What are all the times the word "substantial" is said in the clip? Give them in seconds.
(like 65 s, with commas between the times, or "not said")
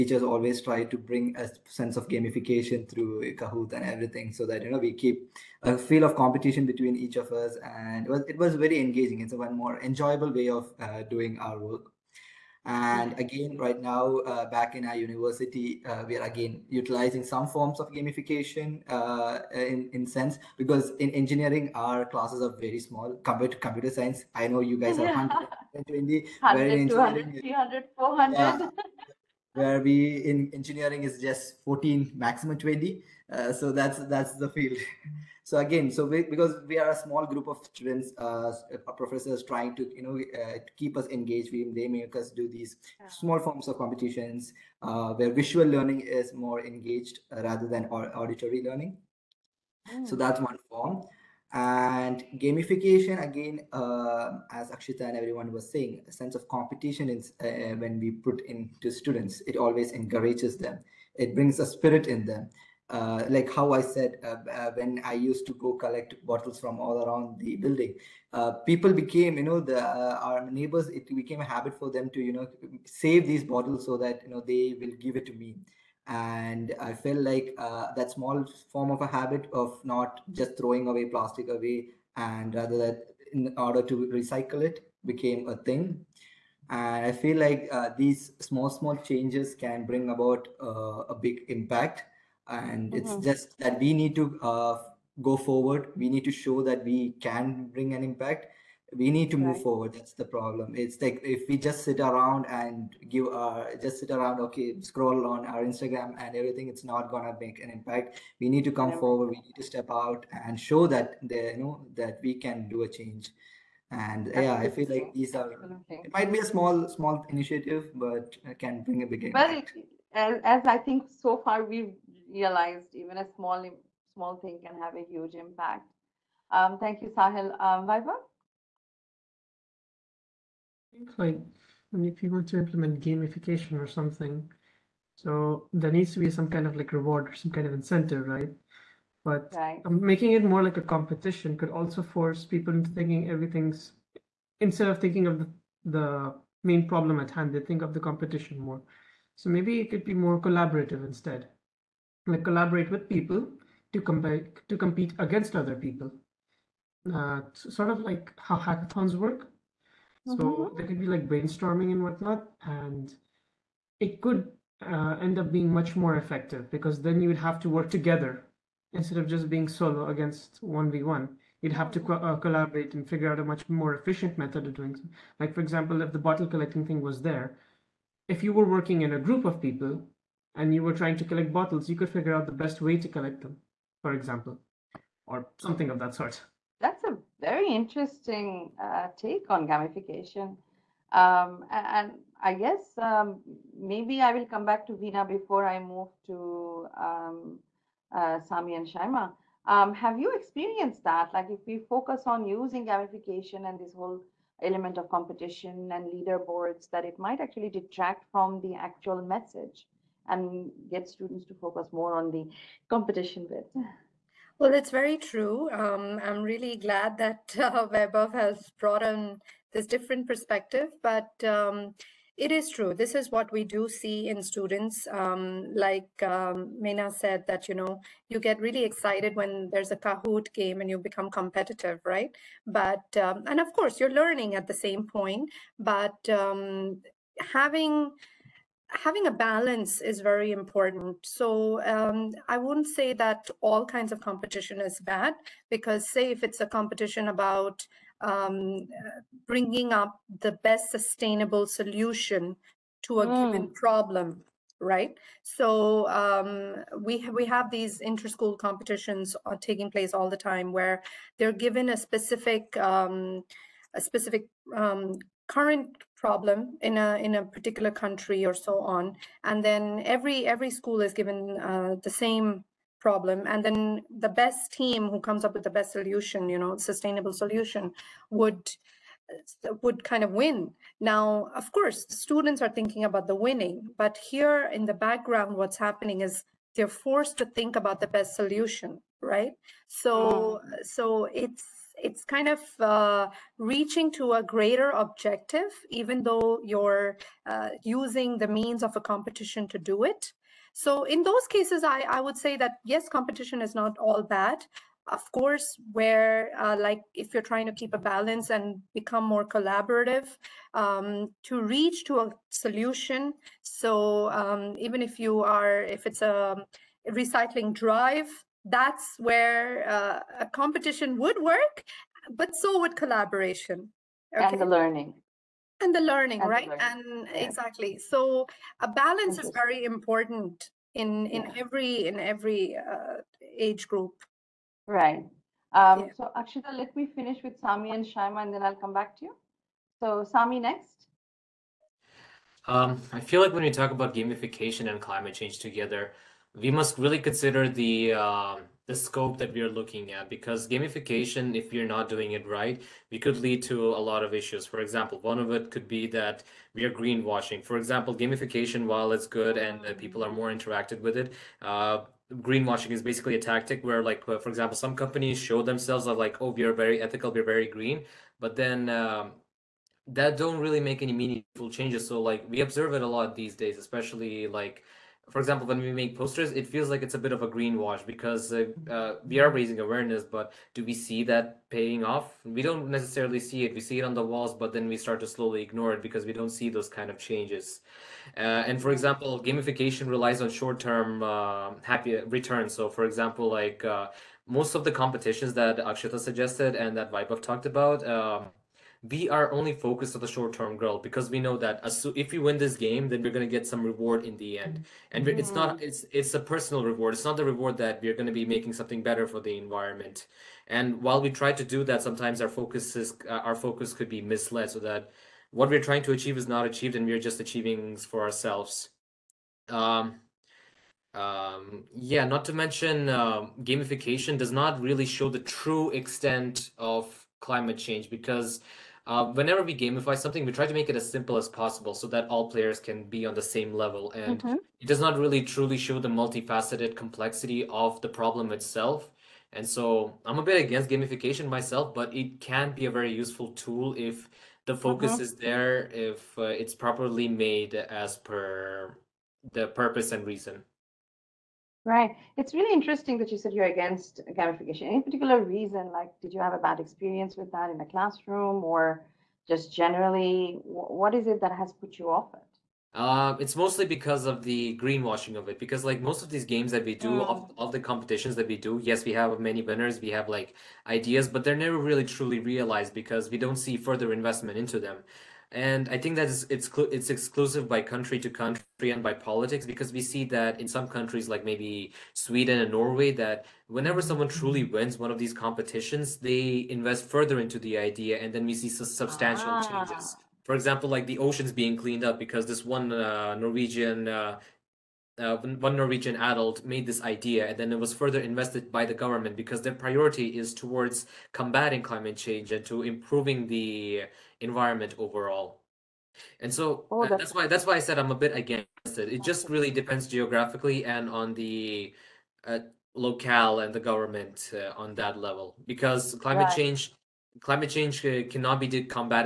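488 s.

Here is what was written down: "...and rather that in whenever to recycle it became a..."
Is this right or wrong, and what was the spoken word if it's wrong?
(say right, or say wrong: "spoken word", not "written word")
wrong: "order", not "whenever".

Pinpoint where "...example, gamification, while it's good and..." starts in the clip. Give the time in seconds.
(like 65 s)
357 s.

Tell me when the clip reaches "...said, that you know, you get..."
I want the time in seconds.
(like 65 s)
227 s.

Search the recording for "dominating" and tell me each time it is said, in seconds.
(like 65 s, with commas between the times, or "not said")
not said.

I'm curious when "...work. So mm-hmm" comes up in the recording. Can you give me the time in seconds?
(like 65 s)
159 s.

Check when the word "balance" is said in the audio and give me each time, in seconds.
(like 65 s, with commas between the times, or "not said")
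239 s, 307 s, 328 s.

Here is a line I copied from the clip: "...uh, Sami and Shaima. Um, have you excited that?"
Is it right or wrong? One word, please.
wrong.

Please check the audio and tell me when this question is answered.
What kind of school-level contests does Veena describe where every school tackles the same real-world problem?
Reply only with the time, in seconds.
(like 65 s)
258 s.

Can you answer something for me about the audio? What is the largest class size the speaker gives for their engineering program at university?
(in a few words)
20.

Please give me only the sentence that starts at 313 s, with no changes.
So um, even if you are, if it's a recycling drive, that's where uh, a competition would work, but so would collaboration.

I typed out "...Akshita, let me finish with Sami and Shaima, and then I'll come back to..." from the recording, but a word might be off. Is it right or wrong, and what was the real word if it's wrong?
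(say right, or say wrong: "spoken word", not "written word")
right.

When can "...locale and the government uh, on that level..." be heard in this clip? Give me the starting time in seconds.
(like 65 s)
512 s.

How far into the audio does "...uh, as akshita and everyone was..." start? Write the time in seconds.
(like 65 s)
53 s.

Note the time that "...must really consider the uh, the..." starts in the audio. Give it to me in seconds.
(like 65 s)
346 s.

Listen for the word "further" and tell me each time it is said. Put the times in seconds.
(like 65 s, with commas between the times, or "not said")
473 s, 487 s, 497 s.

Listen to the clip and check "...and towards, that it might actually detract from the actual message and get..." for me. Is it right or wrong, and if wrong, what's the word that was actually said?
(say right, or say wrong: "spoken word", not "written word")
wrong: "leaderboards", not "towards".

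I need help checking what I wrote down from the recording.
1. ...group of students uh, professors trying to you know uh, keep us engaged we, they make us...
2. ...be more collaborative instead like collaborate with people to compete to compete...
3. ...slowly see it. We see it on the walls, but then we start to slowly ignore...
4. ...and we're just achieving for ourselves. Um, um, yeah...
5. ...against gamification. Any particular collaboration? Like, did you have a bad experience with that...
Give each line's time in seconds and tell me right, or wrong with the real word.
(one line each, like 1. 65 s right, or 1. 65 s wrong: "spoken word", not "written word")
1. 37 s right
2. 150 s right
3. 382 s wrong: "necessarily", not "slowly"
4. 416 s right
5. 453 s wrong: "reason", not "collaboration".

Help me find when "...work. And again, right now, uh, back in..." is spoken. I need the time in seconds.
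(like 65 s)
11 s.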